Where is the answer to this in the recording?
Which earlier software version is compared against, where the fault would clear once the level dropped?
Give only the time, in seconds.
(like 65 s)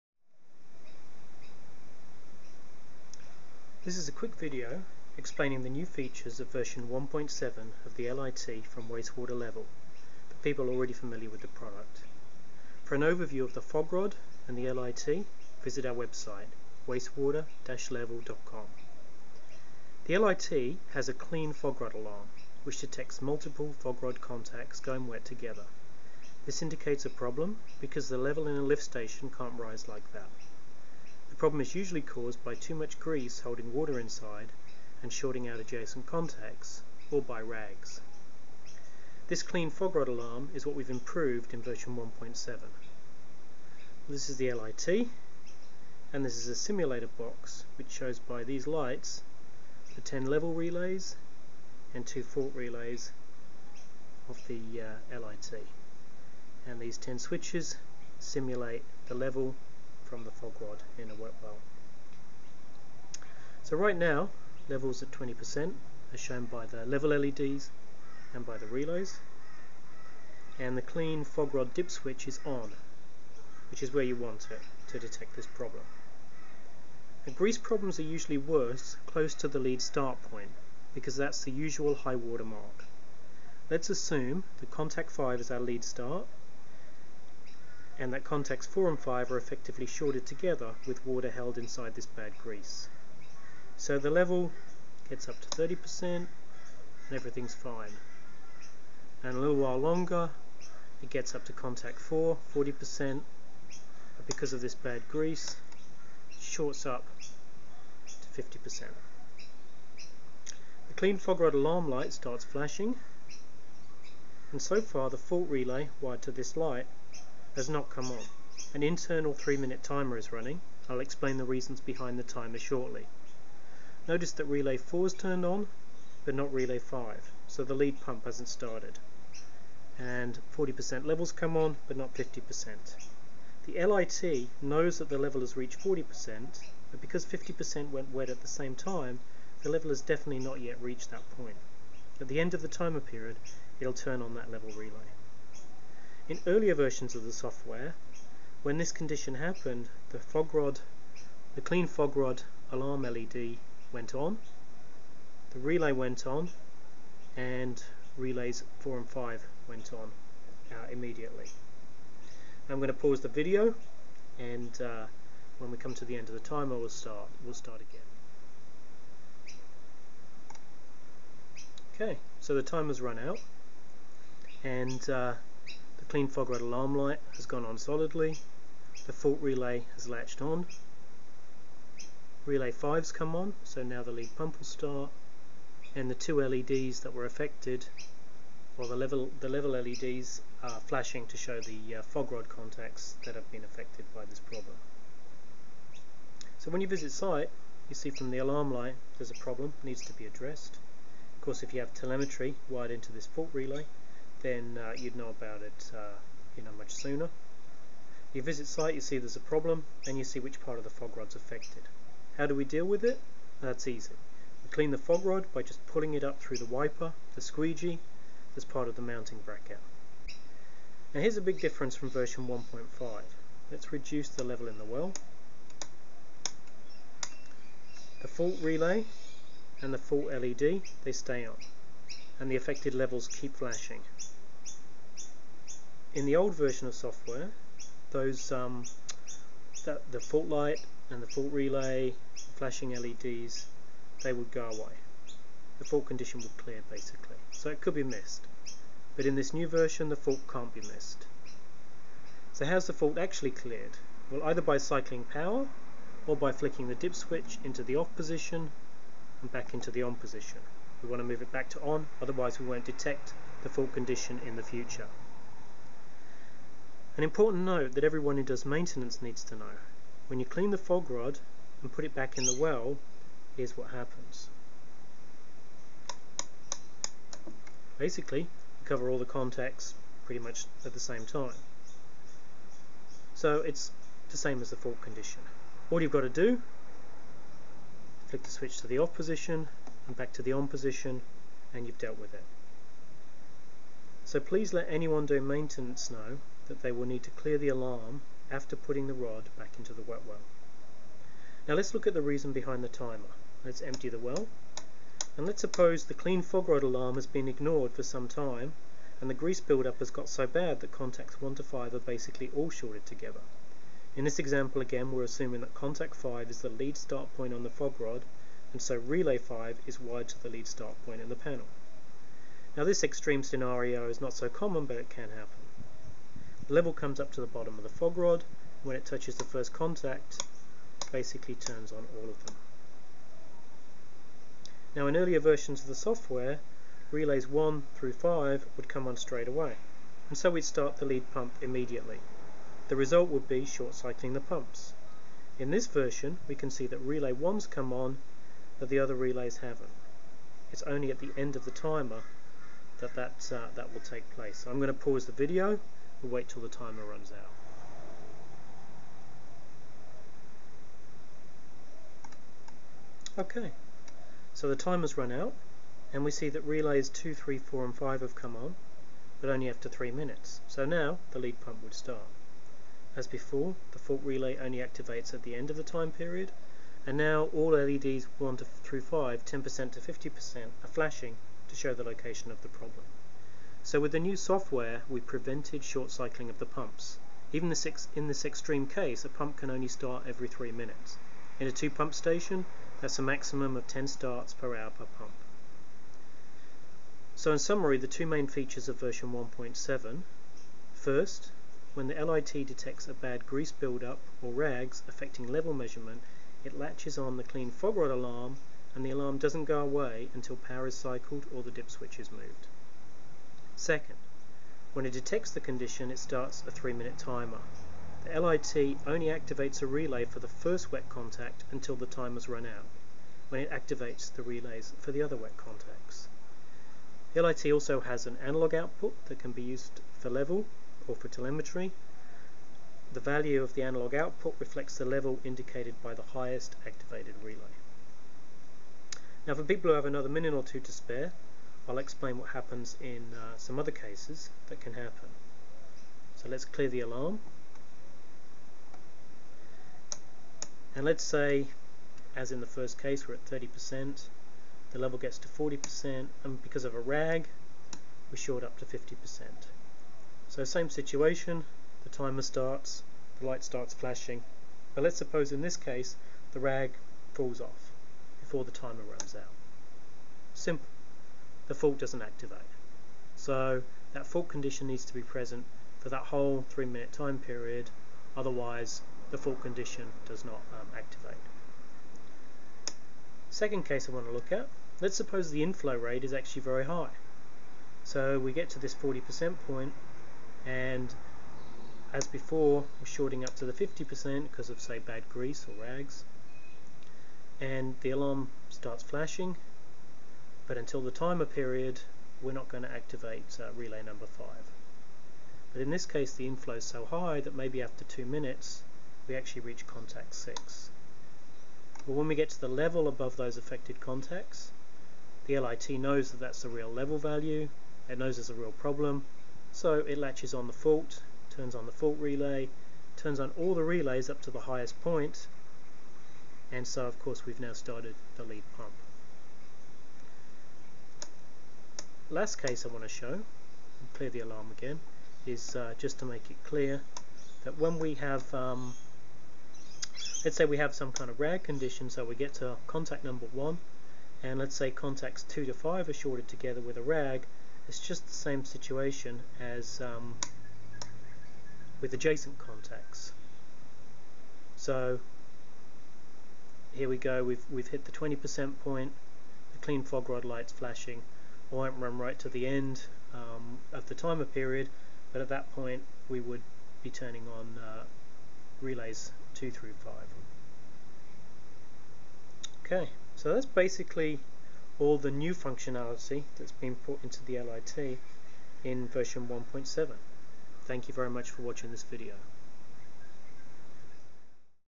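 222 s.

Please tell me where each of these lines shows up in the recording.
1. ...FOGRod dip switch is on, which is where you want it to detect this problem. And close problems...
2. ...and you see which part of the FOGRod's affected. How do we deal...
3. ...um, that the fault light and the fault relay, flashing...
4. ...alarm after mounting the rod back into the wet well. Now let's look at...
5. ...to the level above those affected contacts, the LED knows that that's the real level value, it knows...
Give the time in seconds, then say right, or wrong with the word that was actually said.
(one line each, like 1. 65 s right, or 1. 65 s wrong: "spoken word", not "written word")
1. 71 s wrong: "grease", not "close"
2. 210 s right
3. 238 s right
4. 297 s wrong: "putting", not "mounting"
5. 512 s wrong: "LIT", not "LED".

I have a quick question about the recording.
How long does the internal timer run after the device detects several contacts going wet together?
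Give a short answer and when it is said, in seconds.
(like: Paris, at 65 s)
3 minutes, at 119 s.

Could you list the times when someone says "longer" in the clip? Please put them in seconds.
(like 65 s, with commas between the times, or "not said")
99 s.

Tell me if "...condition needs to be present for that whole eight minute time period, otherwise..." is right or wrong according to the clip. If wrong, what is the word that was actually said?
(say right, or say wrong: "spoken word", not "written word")
wrong: "three", not "eight".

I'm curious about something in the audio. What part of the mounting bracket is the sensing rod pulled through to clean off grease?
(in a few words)
the squeegee.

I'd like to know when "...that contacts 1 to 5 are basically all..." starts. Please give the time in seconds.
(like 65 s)
310 s.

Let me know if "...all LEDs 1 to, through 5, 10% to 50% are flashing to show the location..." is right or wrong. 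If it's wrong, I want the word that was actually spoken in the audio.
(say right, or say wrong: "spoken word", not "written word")
right.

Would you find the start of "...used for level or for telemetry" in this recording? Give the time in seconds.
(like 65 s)
429 s.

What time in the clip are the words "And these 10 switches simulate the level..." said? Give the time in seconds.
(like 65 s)
56 s.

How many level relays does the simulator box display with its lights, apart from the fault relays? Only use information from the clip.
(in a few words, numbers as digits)
10.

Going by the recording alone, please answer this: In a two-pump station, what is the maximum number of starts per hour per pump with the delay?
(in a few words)
10.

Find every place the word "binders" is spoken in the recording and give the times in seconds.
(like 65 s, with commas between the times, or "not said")
not said.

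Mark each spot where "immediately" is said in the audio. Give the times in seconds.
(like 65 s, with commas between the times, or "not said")
160 s, 341 s.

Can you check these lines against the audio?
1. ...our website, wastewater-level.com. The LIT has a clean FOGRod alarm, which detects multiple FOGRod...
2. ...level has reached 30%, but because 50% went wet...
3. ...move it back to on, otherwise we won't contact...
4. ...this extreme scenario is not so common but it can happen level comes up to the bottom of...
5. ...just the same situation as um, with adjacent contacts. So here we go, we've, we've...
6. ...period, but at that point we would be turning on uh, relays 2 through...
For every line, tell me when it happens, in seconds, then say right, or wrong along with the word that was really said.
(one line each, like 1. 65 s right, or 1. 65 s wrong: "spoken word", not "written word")
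1. 15 s right
2. 135 s wrong: "40", not "30"
3. 261 s wrong: "detect", not "contact"
4. 322 s right
5. 547 s right
6. 564 s right.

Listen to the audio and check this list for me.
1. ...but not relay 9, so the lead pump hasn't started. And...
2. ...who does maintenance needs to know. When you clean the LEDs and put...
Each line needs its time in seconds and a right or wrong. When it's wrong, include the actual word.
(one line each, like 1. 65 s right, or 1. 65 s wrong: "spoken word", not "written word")
1. 126 s wrong: "5", not "9"
2. 268 s wrong: "FOGRod", not "LEDs".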